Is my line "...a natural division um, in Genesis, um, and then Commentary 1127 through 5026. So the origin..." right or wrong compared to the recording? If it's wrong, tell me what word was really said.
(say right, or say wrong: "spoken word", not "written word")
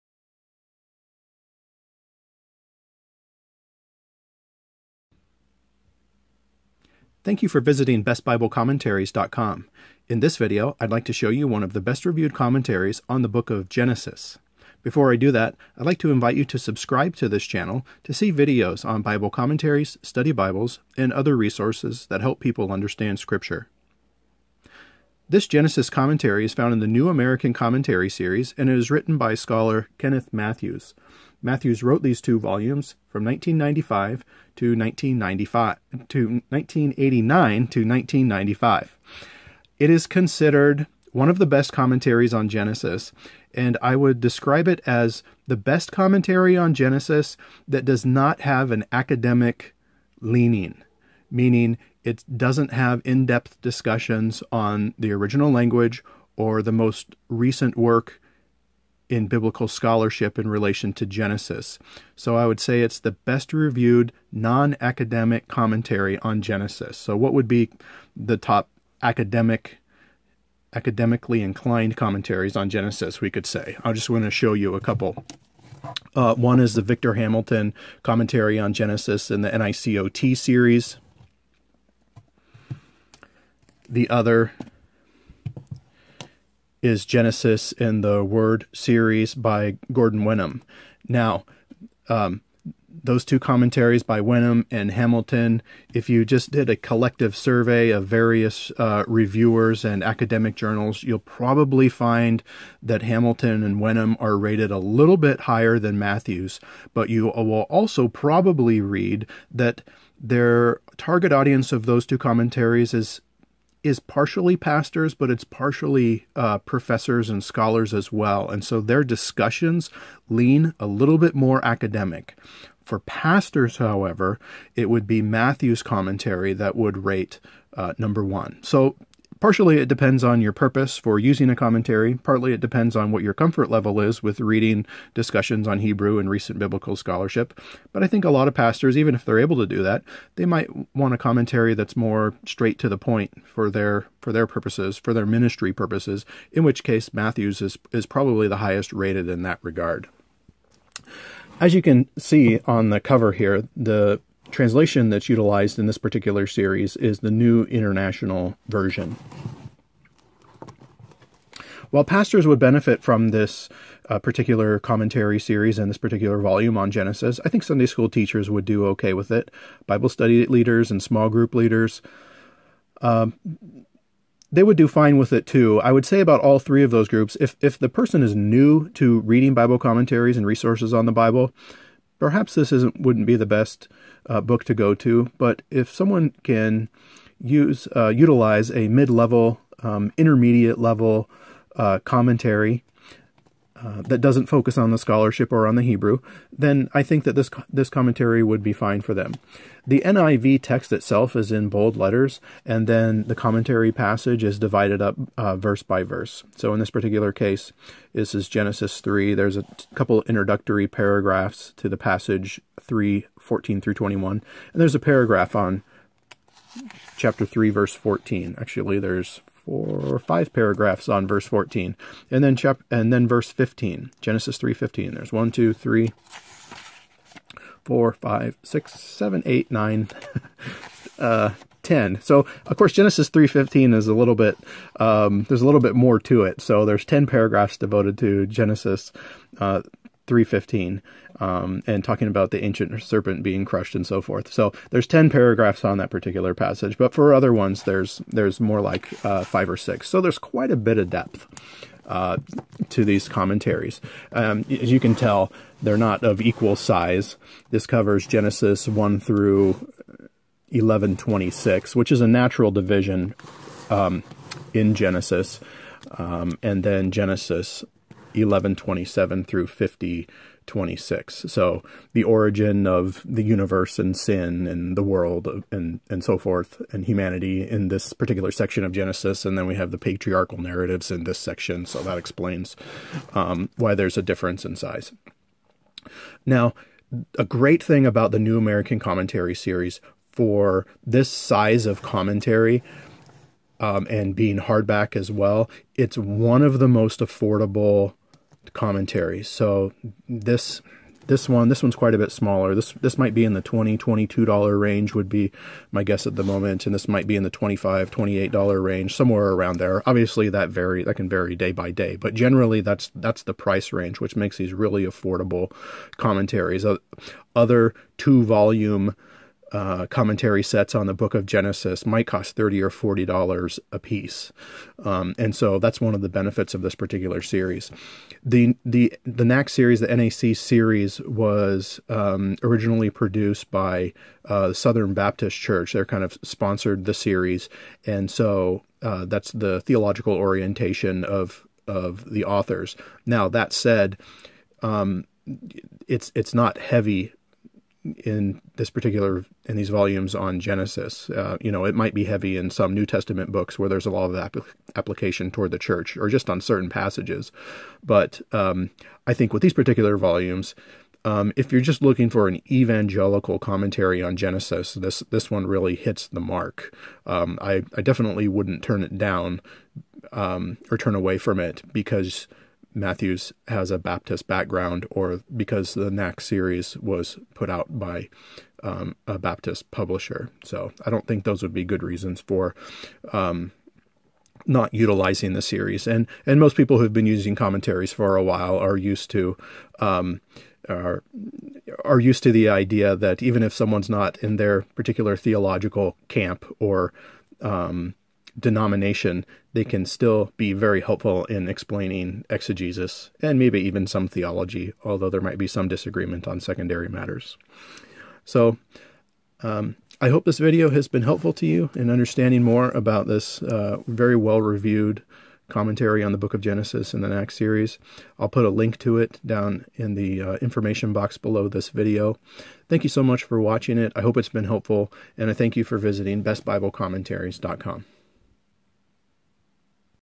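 wrong: "Genesis", not "Commentary".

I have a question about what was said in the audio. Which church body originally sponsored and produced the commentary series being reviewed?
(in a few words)
Southern Baptist Church.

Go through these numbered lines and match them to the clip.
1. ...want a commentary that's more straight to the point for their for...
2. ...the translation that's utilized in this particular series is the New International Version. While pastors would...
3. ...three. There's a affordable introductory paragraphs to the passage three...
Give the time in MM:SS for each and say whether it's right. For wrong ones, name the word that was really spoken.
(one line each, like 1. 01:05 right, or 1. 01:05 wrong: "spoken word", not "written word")
1. 02:20 right
2. 02:33 right
3. 03:29 wrong: "couple", not "affordable".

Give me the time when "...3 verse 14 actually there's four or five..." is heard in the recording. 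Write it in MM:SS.
03:37.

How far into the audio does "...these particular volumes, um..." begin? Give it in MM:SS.
05:59.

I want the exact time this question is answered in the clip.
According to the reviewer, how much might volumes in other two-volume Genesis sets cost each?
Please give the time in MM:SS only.
05:22.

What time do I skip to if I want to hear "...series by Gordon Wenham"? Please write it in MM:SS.
01:28.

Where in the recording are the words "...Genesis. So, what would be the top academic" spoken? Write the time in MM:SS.
01:06.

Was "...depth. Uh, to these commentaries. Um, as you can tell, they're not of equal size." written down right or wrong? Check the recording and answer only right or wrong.
right.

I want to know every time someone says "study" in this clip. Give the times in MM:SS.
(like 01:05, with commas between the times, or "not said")
00:20, 02:50.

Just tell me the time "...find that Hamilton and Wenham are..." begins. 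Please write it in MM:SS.
01:41.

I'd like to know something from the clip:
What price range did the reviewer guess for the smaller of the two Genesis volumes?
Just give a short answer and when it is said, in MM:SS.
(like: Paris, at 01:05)
$20 to $22, at 05:03.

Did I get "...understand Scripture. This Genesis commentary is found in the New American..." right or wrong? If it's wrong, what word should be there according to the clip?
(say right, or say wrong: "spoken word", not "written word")
right.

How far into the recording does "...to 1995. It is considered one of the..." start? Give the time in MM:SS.
00:37.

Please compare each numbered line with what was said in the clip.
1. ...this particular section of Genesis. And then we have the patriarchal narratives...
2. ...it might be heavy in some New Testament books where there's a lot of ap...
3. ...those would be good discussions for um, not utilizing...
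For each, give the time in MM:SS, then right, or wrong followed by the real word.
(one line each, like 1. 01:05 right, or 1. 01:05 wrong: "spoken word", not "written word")
1. 04:37 right
2. 05:51 right
3. 06:21 wrong: "reasons", not "discussions".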